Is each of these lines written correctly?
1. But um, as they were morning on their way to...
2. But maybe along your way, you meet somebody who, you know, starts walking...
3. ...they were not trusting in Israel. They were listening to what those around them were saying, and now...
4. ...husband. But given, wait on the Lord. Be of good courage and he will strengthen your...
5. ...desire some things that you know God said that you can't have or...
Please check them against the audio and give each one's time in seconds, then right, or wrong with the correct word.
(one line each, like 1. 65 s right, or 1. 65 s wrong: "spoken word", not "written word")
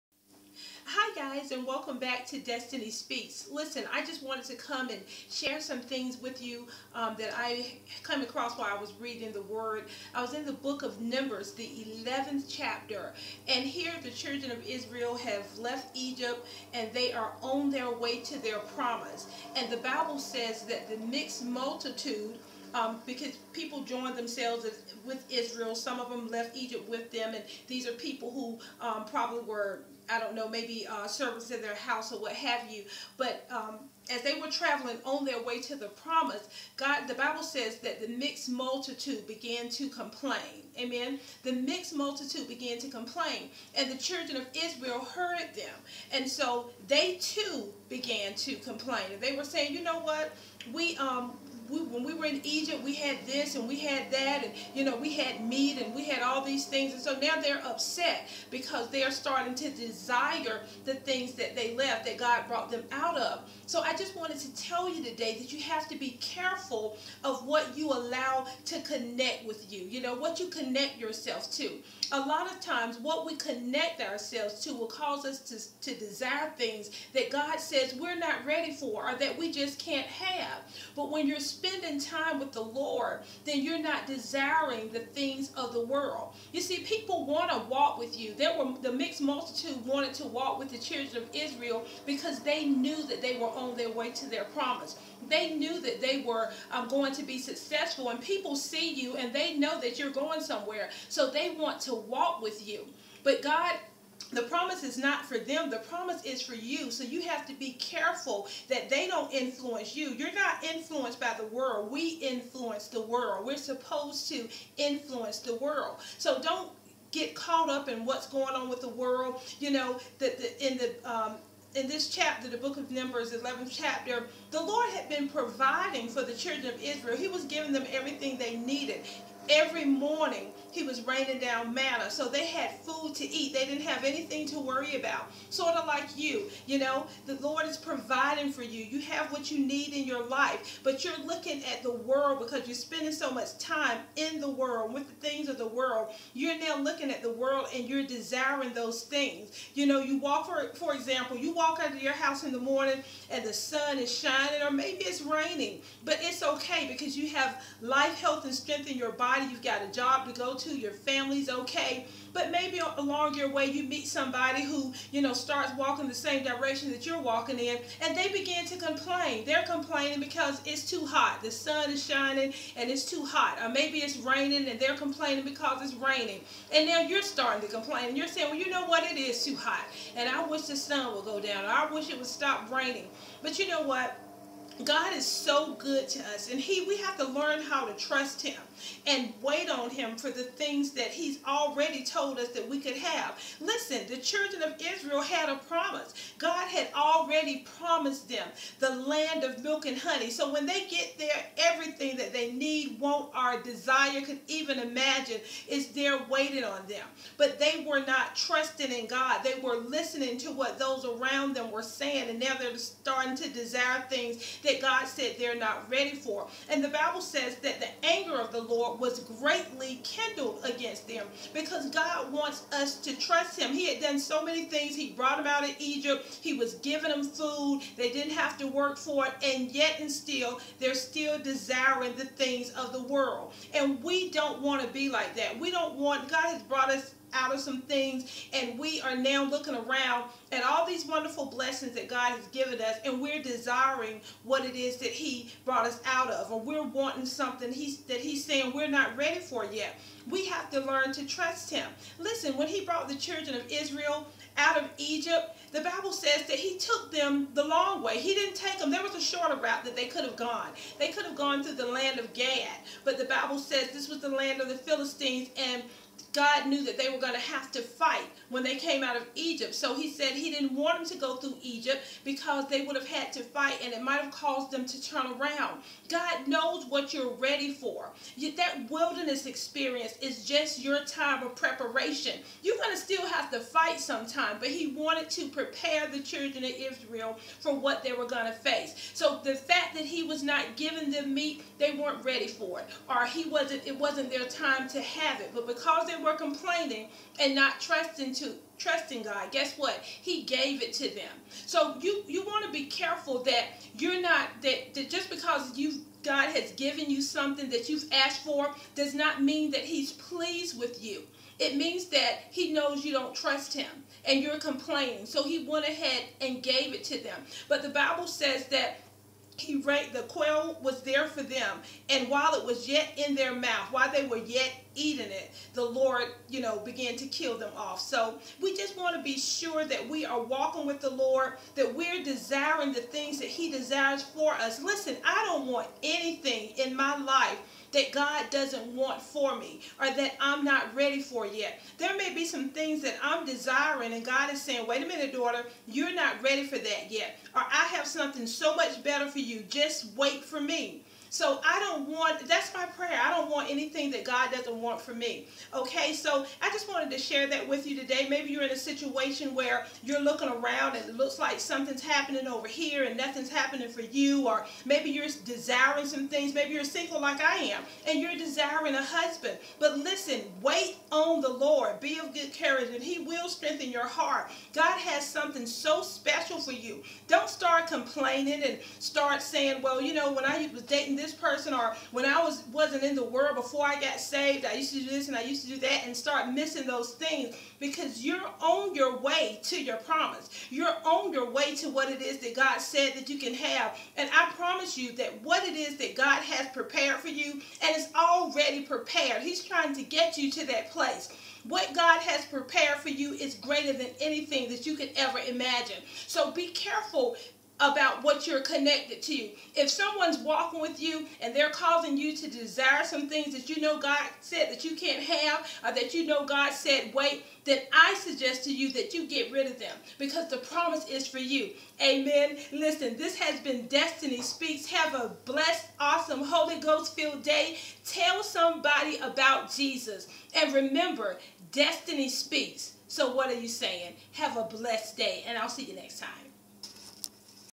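1. 33 s wrong: "traveling", not "morning"
2. 162 s right
3. 207 s wrong: "God", not "Israel"
4. 369 s wrong: "listen", not "given"
5. 412 s right.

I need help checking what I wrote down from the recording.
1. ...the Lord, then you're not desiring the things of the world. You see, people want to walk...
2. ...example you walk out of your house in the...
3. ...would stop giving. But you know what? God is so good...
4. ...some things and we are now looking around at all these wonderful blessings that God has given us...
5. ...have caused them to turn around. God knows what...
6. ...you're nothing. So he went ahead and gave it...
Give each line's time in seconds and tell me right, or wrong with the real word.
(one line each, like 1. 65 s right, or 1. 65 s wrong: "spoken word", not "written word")
1. 82 s right
2. 150 s right
3. 182 s wrong: "raining", not "giving"
4. 237 s right
5. 274 s right
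6. 314 s wrong: "complaining", not "nothing".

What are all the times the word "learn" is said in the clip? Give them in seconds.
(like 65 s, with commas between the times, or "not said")
187 s, 250 s.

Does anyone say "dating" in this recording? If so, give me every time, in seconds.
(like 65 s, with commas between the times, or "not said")
380 s.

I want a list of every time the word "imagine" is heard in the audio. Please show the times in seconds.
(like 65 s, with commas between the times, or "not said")
204 s, 405 s.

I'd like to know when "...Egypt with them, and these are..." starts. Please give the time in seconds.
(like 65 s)
26 s.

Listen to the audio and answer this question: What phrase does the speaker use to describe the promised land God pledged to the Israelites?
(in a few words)
Land of milk and honey.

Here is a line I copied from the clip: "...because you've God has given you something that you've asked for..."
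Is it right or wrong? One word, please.
right.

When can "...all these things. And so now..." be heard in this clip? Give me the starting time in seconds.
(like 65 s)
56 s.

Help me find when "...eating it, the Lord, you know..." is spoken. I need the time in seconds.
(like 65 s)
324 s.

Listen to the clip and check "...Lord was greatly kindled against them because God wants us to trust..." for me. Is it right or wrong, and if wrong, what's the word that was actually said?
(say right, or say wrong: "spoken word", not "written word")
right.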